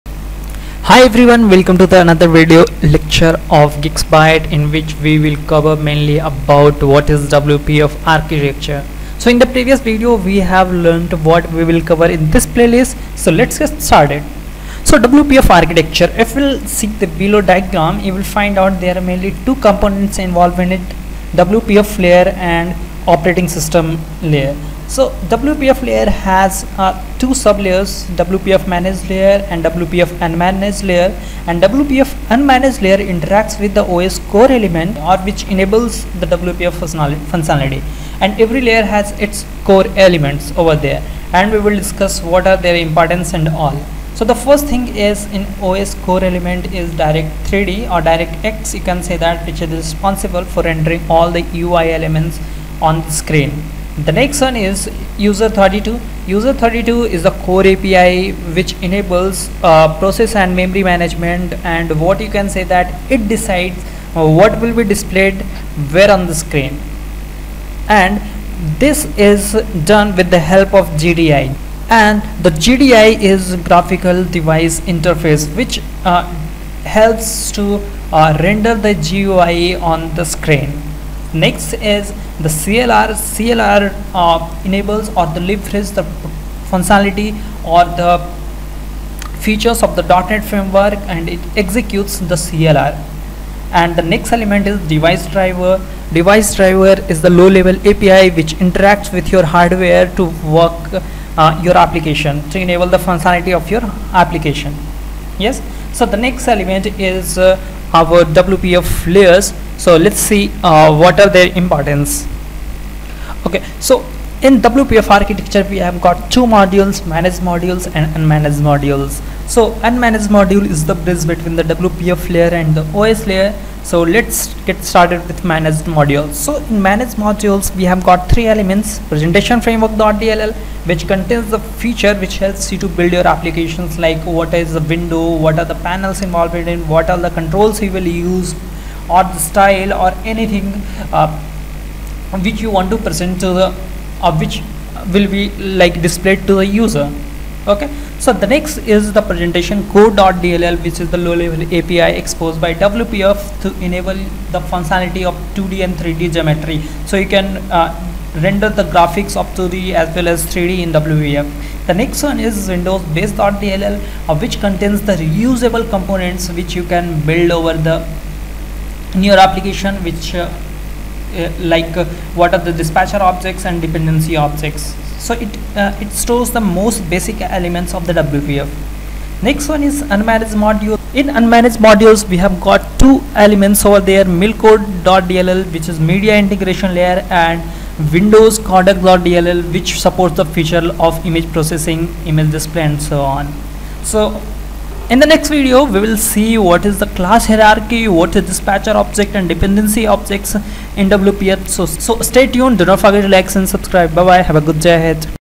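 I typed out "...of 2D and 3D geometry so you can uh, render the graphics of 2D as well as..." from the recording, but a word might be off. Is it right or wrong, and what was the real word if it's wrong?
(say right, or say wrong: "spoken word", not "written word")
right.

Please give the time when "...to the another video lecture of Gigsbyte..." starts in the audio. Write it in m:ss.
0:01.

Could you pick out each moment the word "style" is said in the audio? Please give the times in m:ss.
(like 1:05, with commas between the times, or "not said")
2:19.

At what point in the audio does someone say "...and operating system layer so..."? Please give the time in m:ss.
0:22.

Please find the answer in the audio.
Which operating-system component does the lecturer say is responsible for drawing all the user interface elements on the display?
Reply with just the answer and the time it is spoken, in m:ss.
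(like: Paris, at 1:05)
Direct3D, at 0:46.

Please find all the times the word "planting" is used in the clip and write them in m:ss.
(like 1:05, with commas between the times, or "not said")
not said.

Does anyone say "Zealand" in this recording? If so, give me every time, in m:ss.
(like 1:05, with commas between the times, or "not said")
not said.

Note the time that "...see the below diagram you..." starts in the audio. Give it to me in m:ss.
0:16.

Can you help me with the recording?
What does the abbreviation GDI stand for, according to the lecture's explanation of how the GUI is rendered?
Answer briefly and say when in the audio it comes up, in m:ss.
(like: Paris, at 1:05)
Graphical device interface, at 1:13.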